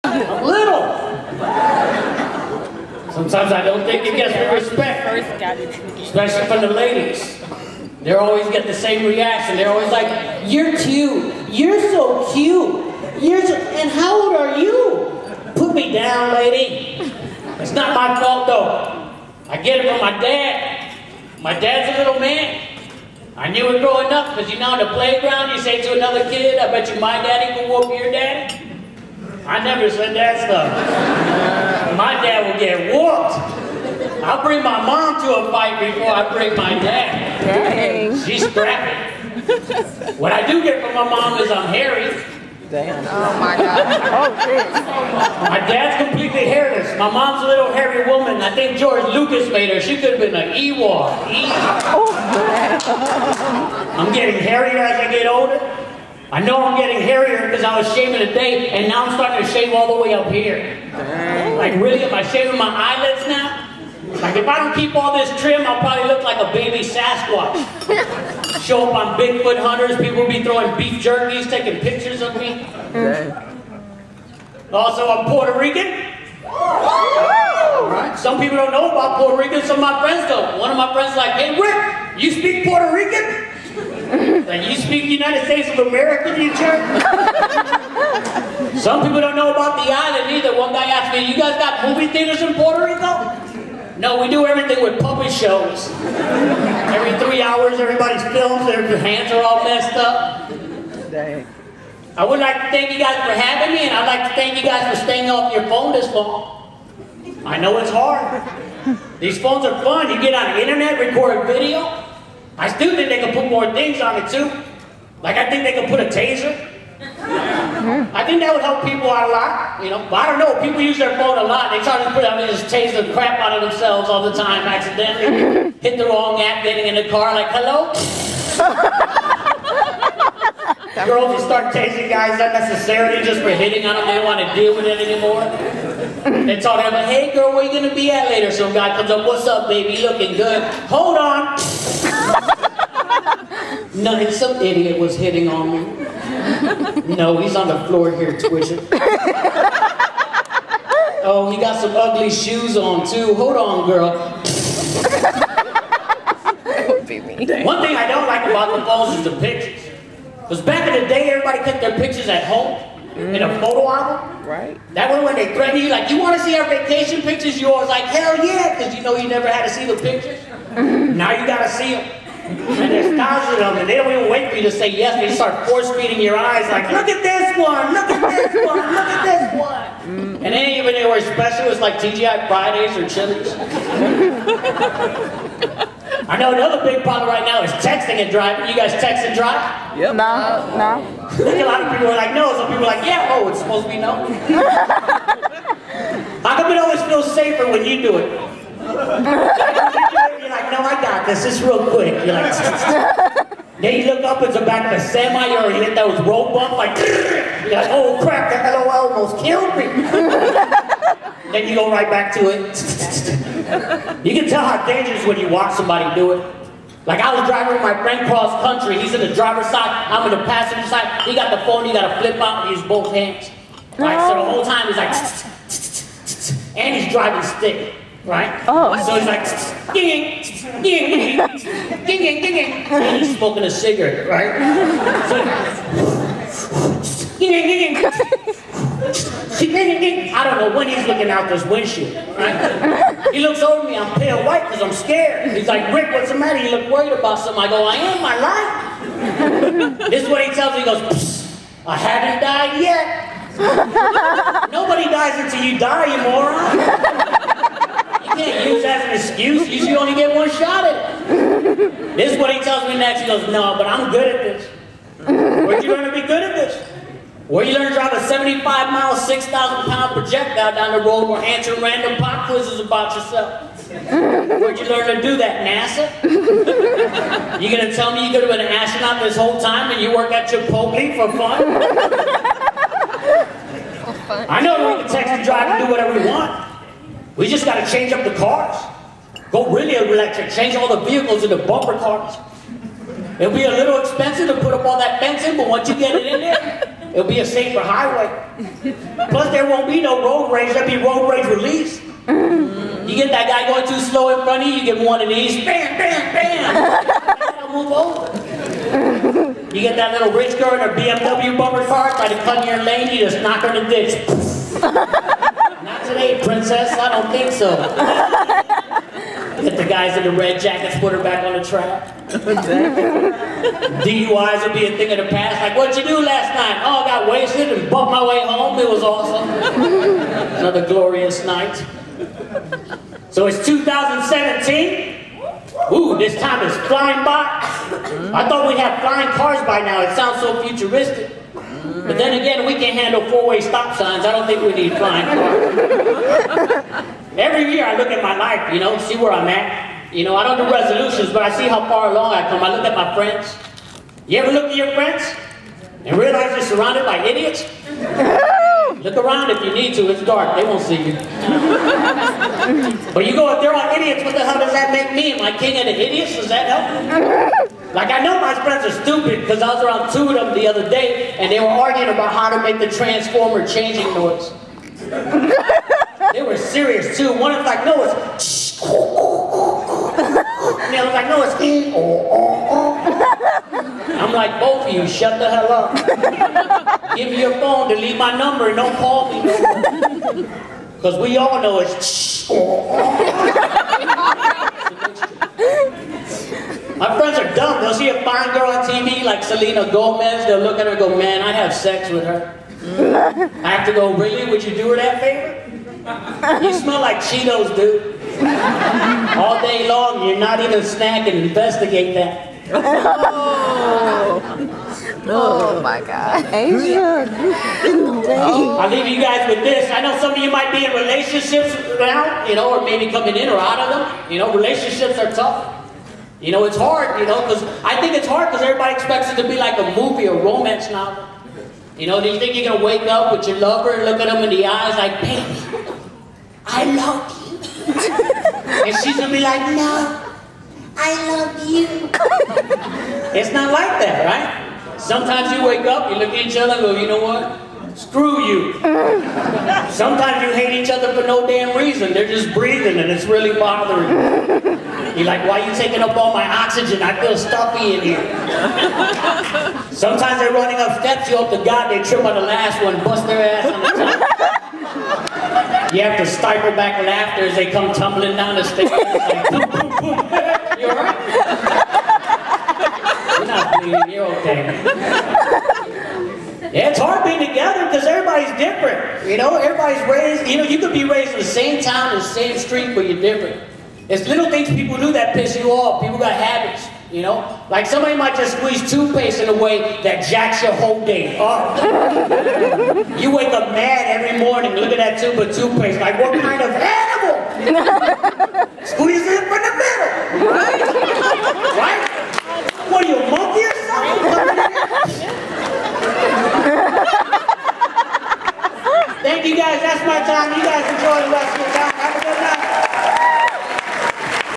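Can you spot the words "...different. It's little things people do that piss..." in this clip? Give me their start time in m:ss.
8:03.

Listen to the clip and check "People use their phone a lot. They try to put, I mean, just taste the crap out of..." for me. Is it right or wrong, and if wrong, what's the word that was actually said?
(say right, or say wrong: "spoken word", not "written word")
right.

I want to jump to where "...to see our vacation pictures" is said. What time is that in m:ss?
2:46.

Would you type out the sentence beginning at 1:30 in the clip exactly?
One guy asked me, you guys got movie theaters in Puerto Rico?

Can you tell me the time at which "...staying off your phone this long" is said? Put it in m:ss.
1:45.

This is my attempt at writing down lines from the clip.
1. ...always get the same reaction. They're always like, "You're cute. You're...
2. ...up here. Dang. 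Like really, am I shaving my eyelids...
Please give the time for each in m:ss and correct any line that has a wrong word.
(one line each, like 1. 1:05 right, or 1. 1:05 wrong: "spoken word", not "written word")
1. 0:08 right
2. 1:00 right.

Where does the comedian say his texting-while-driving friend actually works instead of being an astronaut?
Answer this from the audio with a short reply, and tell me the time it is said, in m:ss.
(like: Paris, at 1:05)
Chipotle, at 4:40.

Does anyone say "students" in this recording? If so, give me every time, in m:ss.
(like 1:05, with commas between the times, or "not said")
not said.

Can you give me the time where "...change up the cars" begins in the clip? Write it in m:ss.
4:47.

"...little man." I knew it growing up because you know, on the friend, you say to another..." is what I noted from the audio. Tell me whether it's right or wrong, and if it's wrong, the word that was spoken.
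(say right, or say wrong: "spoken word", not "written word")
wrong: "playground", not "friend".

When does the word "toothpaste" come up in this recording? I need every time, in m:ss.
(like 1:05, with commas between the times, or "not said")
8:08, 8:15.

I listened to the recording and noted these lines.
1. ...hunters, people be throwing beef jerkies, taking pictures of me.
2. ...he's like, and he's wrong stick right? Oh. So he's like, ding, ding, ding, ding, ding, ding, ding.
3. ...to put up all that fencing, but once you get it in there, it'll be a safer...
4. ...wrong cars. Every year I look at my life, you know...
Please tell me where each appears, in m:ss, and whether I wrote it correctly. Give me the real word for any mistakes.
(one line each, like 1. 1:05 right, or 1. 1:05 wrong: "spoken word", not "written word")
1. 1:09 right
2. 3:44 wrong: "driving", not "wrong"
3. 4:54 right
4. 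5:44 wrong: "flying", not "wrong".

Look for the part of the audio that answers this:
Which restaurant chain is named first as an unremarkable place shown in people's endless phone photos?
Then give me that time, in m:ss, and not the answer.
3:01.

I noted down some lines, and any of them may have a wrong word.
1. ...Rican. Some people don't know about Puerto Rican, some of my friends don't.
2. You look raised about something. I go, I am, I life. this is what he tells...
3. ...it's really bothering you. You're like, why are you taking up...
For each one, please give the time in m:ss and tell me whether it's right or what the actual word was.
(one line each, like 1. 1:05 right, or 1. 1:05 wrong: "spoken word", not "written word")
1. 1:15 right
2. 4:06 wrong: "worried", not "raised"
3. 7:33 right.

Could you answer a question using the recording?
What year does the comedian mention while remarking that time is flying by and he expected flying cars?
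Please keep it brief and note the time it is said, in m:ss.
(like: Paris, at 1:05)
2017, at 5:33.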